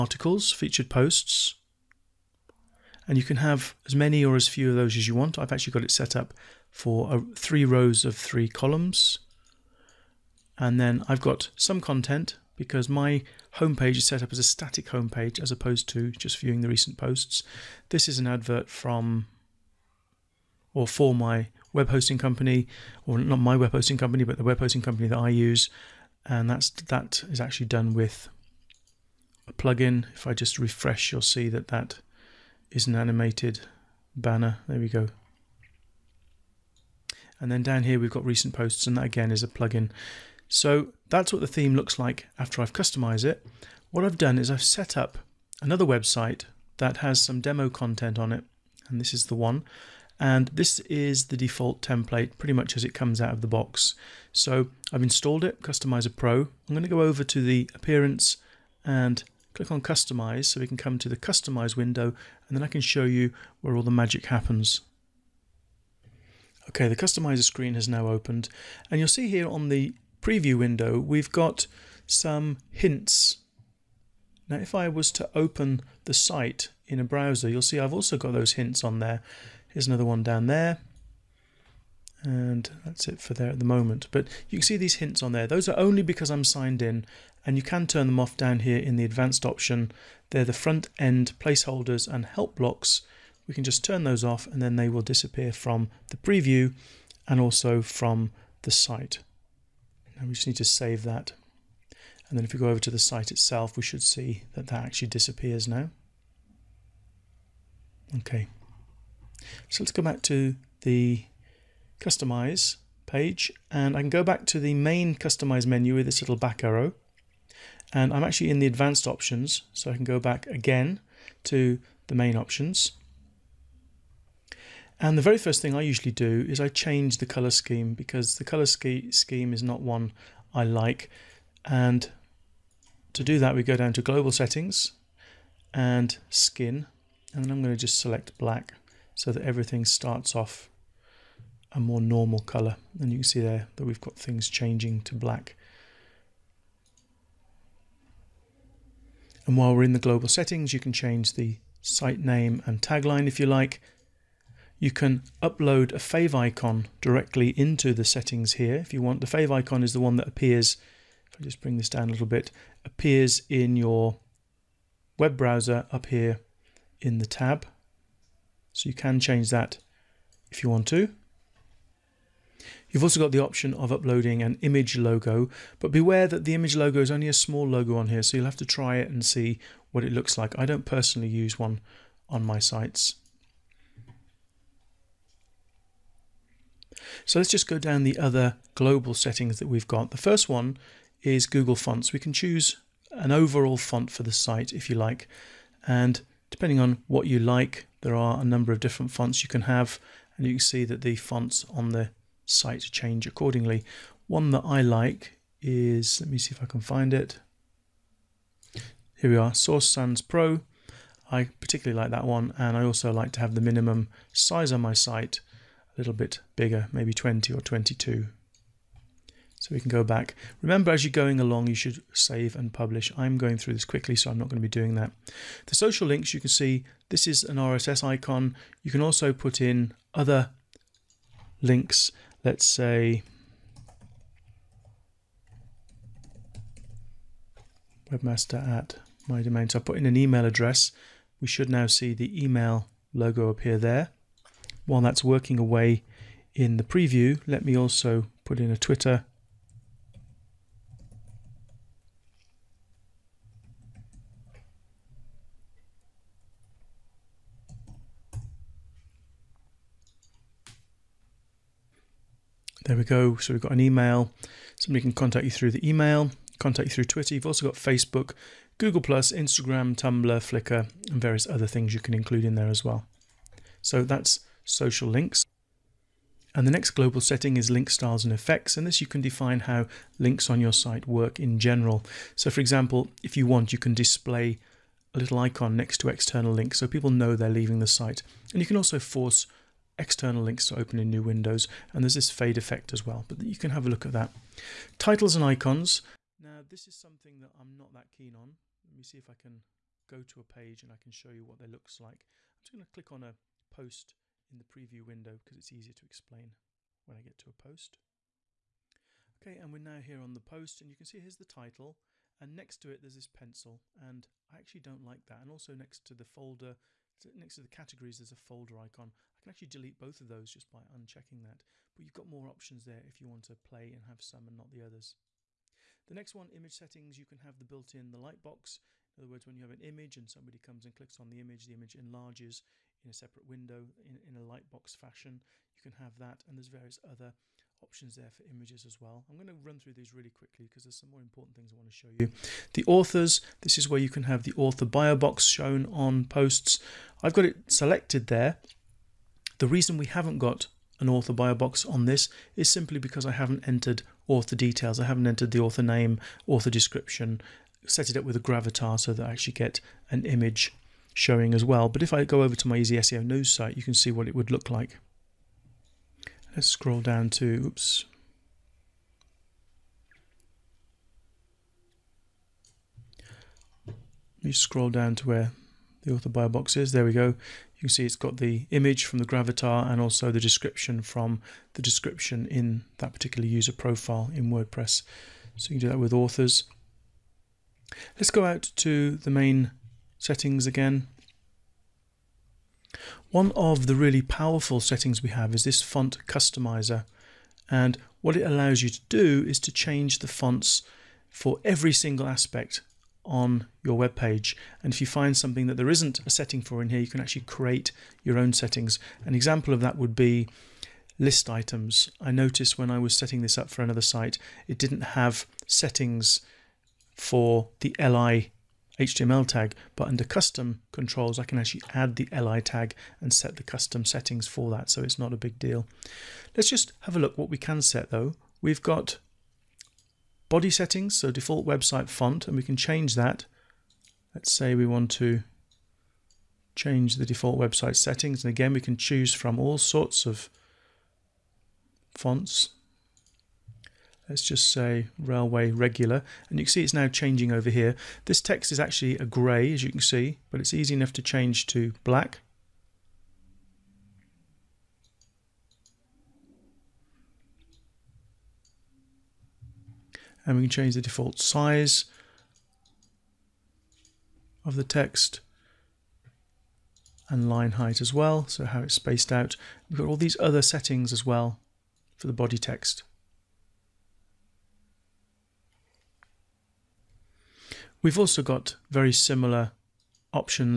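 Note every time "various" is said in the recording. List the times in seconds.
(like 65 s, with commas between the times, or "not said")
271 s, 336 s.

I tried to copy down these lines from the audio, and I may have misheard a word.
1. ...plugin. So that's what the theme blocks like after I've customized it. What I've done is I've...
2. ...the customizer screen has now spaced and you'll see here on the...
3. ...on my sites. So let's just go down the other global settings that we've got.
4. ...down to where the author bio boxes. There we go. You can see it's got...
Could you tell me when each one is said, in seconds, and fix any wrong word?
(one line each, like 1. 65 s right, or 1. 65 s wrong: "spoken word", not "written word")
1. 39 s wrong: "looks", not "blocks"
2. 66 s wrong: "opened", not "spaced"
3. 182 s right
4. 374 s right.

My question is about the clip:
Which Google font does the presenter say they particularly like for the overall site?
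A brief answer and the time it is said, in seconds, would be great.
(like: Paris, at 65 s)
Source Sans Pro, at 209 s.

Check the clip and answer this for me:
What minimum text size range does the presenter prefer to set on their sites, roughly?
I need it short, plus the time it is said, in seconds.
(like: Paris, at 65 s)
20 or 22, at 217 s.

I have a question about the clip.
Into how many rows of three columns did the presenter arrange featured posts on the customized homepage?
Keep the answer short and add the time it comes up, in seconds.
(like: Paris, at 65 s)
3, at 7 s.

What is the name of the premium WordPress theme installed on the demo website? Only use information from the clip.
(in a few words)
Customizr Pro.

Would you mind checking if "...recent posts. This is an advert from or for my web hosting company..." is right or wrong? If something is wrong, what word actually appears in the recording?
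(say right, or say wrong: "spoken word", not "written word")
right.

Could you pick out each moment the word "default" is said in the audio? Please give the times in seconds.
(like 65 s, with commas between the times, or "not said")
51 s, 431 s, 437 s, 461 s.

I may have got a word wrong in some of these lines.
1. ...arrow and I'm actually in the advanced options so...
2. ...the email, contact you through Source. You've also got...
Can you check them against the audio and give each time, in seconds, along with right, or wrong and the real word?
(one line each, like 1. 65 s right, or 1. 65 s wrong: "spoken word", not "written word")
1. 116 s right
2. 265 s wrong: "Twitter", not "Source".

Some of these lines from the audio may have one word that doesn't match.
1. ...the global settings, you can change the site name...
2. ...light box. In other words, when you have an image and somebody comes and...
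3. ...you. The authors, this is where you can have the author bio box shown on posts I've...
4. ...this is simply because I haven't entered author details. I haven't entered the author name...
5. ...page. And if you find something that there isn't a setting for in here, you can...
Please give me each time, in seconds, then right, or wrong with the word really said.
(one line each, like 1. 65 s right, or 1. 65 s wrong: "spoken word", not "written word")
1. 149 s right
2. 328 s right
3. 342 s right
4. 352 s right
5. 404 s right.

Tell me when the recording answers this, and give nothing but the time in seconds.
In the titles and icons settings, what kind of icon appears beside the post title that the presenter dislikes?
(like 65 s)
313 s.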